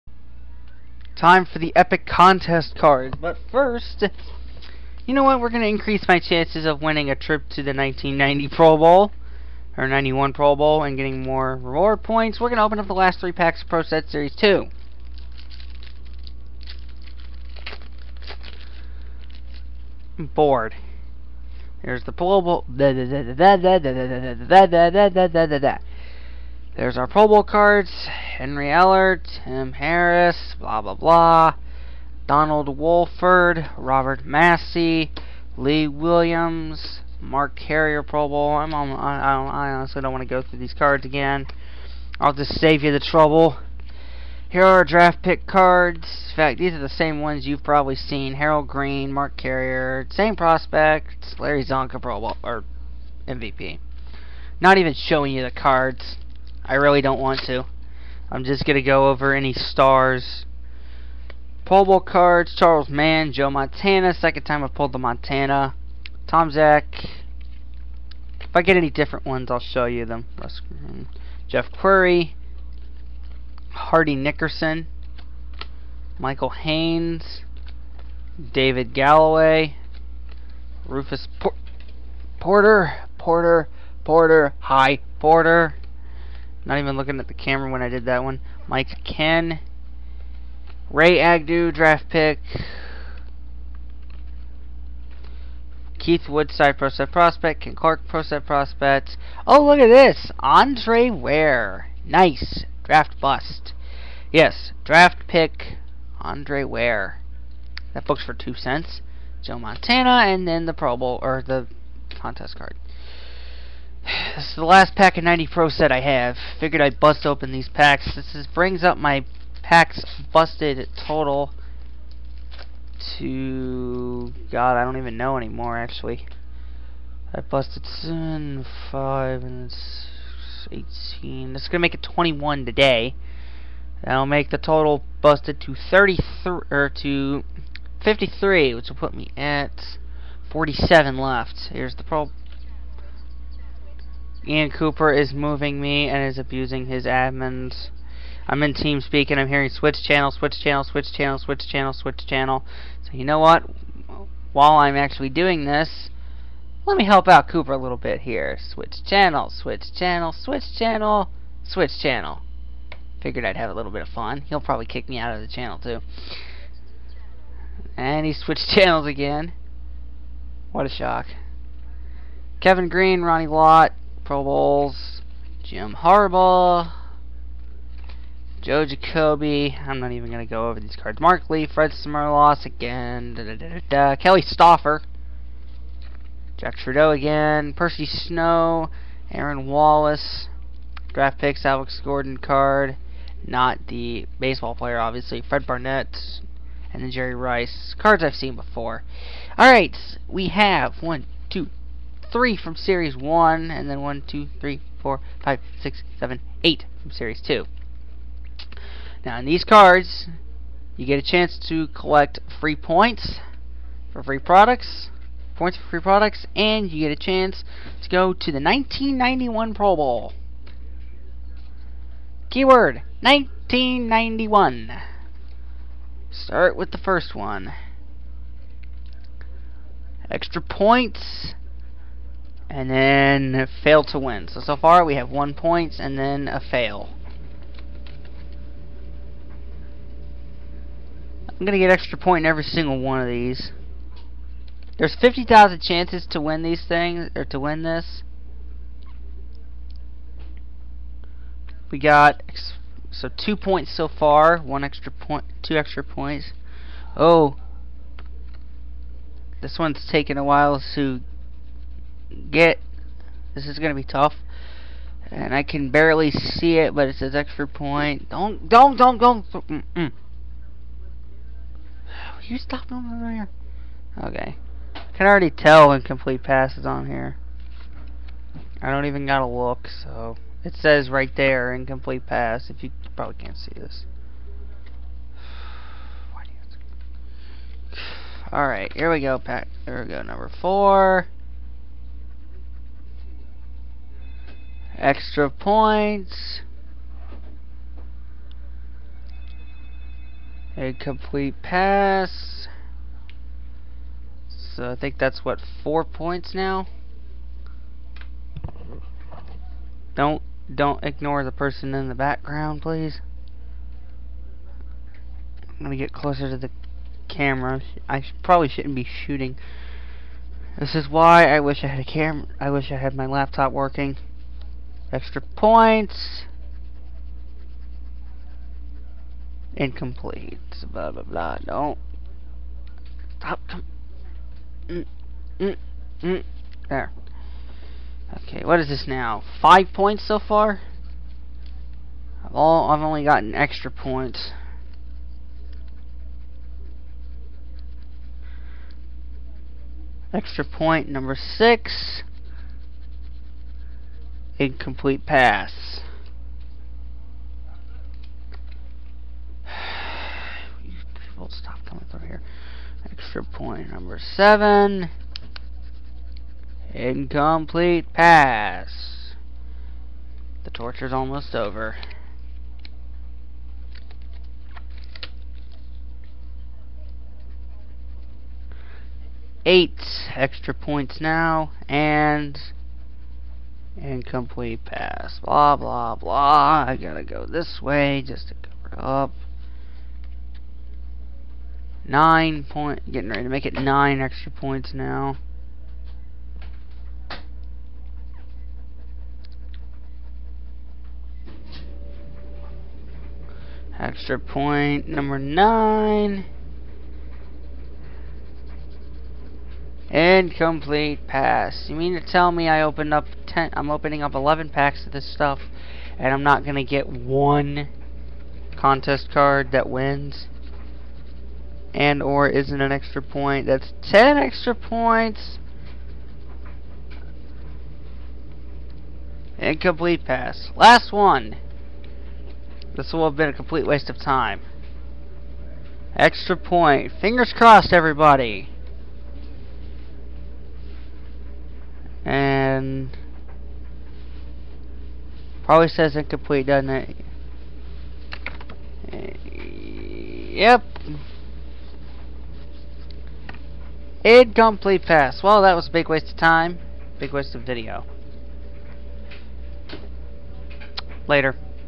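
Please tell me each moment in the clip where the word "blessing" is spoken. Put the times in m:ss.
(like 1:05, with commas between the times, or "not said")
not said.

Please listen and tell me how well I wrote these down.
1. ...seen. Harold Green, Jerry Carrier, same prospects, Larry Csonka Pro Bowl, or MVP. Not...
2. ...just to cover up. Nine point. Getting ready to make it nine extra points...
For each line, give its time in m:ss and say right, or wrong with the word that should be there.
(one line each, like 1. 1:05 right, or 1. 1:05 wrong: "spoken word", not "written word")
1. 0:47 wrong: "Mark", not "Jerry"
2. 6:28 right.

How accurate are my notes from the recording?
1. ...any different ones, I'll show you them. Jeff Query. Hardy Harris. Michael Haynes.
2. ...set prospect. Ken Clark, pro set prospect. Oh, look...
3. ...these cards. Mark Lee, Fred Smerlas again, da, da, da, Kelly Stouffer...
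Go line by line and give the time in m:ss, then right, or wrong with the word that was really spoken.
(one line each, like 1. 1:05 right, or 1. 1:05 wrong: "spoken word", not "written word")
1. 1:08 wrong: "Nickerson", not "Harris"
2. 1:36 right
3. 3:00 right.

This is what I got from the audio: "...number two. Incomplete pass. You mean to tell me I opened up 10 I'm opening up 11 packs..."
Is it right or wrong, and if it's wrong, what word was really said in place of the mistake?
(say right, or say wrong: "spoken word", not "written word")
wrong: "nine", not "two".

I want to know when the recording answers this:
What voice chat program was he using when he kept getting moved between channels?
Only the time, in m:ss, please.
2:28.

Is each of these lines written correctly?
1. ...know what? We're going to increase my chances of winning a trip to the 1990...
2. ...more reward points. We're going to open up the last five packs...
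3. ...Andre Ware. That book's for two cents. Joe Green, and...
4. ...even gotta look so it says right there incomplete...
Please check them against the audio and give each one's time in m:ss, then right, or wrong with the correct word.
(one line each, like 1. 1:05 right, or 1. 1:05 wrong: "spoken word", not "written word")
1. 0:05 right
2. 0:11 wrong: "three", not "five"
3. 1:46 wrong: "Montana", not "Green"
4. 4:39 right.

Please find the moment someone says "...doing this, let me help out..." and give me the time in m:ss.
2:35.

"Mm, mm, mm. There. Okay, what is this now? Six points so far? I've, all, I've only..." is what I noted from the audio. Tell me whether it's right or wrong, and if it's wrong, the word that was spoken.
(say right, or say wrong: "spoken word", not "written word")
wrong: "Five", not "Six".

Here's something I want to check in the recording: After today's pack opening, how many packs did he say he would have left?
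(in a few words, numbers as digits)
47.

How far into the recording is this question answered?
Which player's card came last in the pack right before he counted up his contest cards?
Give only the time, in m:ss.
3:17.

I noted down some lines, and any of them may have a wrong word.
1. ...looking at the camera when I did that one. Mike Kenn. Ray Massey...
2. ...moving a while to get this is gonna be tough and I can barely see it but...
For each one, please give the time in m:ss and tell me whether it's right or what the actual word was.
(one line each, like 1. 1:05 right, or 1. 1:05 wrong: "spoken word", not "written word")
1. 1:26 wrong: "Agnew", not "Massey"
2. 4:20 wrong: "taking", not "moving".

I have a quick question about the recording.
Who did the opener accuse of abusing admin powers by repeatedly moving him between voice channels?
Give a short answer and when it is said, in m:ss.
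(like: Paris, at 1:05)
Ian Cooper, at 2:24.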